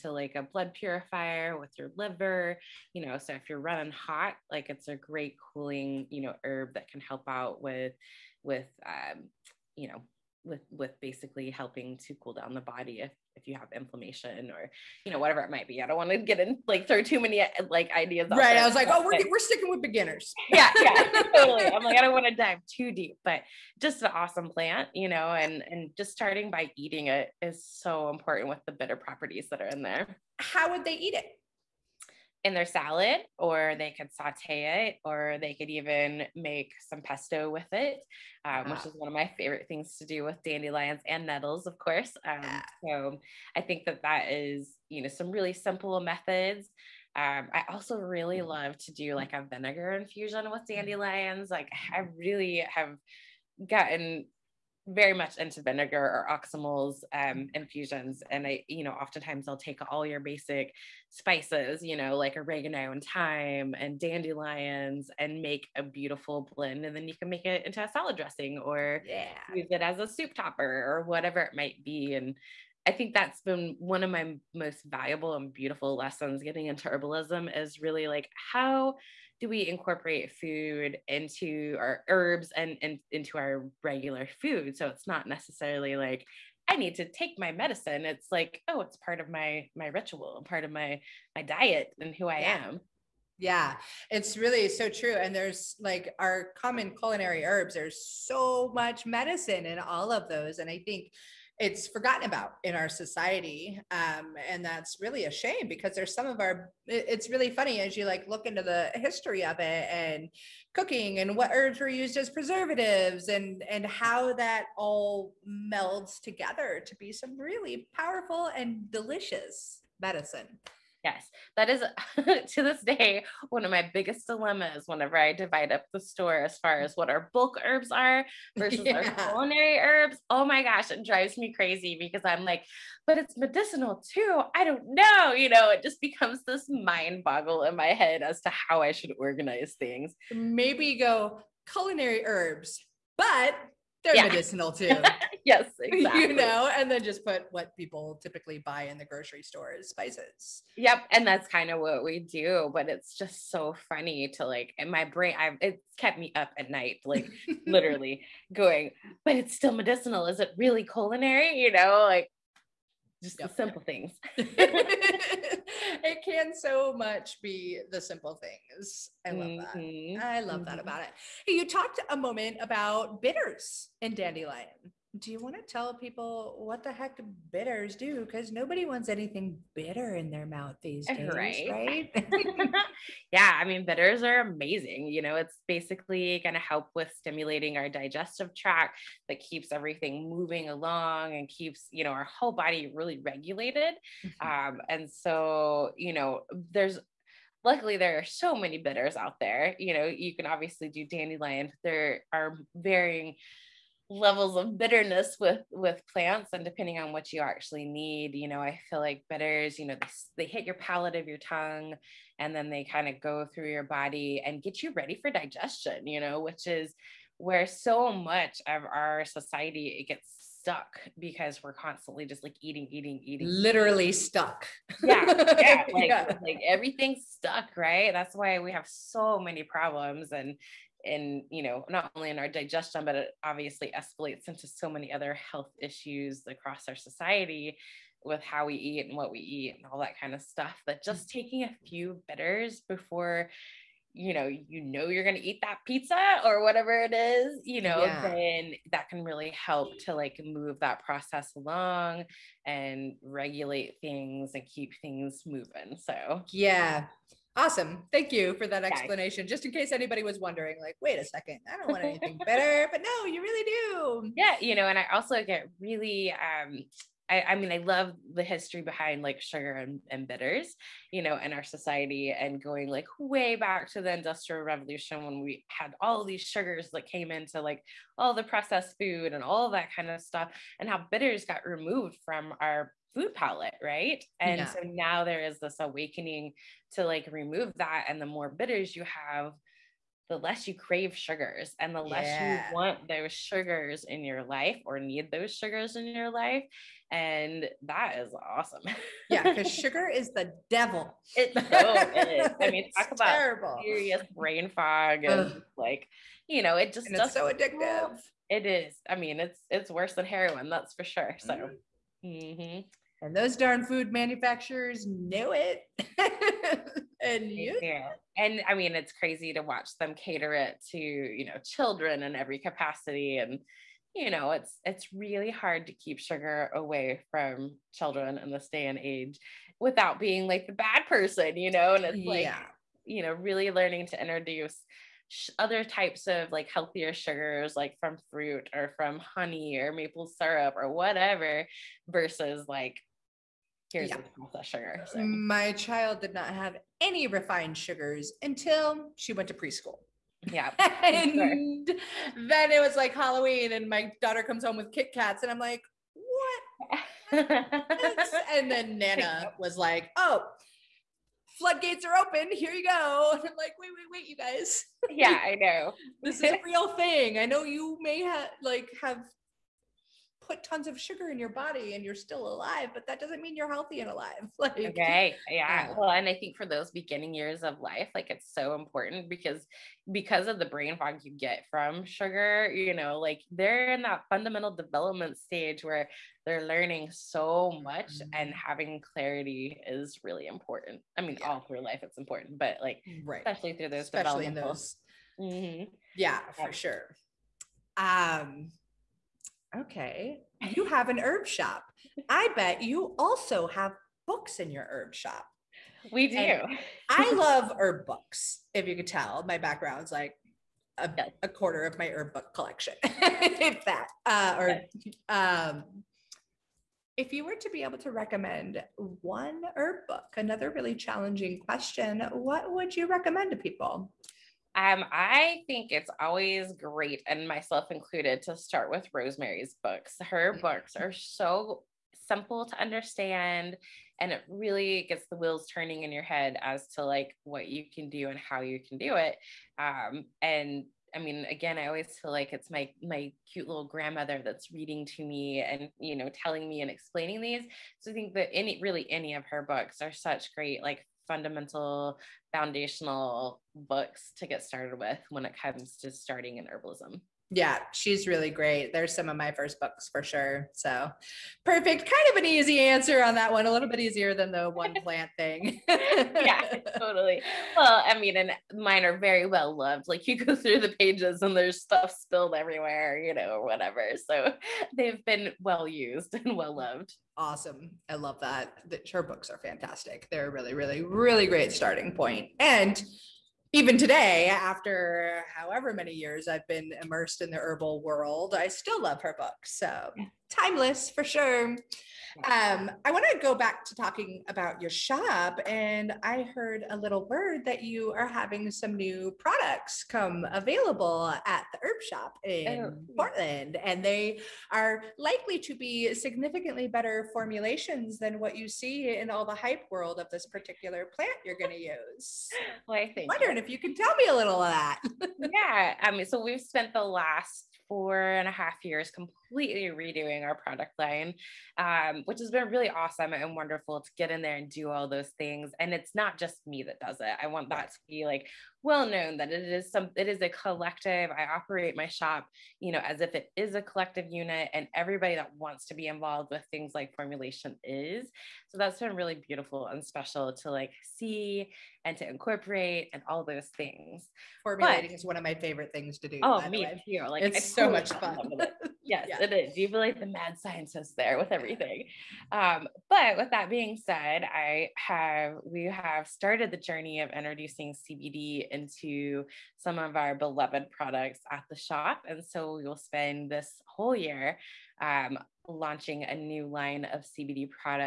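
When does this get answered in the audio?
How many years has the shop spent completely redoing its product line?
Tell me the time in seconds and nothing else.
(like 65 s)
517 s.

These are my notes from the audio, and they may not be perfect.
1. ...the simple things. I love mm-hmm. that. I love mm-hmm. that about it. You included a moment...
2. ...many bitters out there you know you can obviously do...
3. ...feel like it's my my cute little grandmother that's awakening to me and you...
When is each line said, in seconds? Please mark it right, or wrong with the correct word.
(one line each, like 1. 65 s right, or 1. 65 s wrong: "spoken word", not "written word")
1. 167 s wrong: "talked", not "included"
2. 198 s right
3. 442 s wrong: "reading", not "awakening".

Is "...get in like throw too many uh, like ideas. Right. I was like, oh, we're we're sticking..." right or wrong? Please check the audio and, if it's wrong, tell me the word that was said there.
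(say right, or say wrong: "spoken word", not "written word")
right.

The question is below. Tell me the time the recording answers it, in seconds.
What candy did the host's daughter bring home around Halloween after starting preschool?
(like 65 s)
354 s.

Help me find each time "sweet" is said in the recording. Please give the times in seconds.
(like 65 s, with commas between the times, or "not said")
not said.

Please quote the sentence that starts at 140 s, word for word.
Maybe go culinary herbs, but they're yeah.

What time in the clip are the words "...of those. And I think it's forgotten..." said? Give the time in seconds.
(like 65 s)
100 s.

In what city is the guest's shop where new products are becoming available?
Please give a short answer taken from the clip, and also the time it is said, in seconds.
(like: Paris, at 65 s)
Portland, at 503 s.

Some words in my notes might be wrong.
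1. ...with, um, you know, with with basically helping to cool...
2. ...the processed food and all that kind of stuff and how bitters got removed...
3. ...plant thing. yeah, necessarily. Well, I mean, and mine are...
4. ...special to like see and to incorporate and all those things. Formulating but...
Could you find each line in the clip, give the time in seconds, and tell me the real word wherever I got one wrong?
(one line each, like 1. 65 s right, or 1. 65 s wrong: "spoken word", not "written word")
1. 8 s right
2. 278 s right
3. 465 s wrong: "totally", not "necessarily"
4. 540 s right.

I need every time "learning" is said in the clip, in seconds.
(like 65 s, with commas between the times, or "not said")
333 s, 386 s.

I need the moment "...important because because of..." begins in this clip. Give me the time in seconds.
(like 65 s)
378 s.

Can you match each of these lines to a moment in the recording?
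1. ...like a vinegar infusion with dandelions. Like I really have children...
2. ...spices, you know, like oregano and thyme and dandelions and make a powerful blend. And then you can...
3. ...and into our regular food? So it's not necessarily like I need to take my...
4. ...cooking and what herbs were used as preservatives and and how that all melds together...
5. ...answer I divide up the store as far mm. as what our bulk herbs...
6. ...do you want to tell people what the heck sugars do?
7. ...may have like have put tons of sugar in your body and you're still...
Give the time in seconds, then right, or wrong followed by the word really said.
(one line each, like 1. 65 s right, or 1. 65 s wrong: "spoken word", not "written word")
1. 49 s wrong: "gotten", not "children"
2. 61 s wrong: "beautiful", not "powerful"
3. 82 s right
4. 110 s right
5. 124 s wrong: "whenever", not "answer"
6. 175 s wrong: "bitters", not "sugars"
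7. 368 s right.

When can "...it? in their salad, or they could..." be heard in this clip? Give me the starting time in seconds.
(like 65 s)
31 s.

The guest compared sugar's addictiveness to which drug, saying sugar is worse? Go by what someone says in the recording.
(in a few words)
heroin.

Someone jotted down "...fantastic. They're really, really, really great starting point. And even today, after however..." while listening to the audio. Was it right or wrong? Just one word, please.
right.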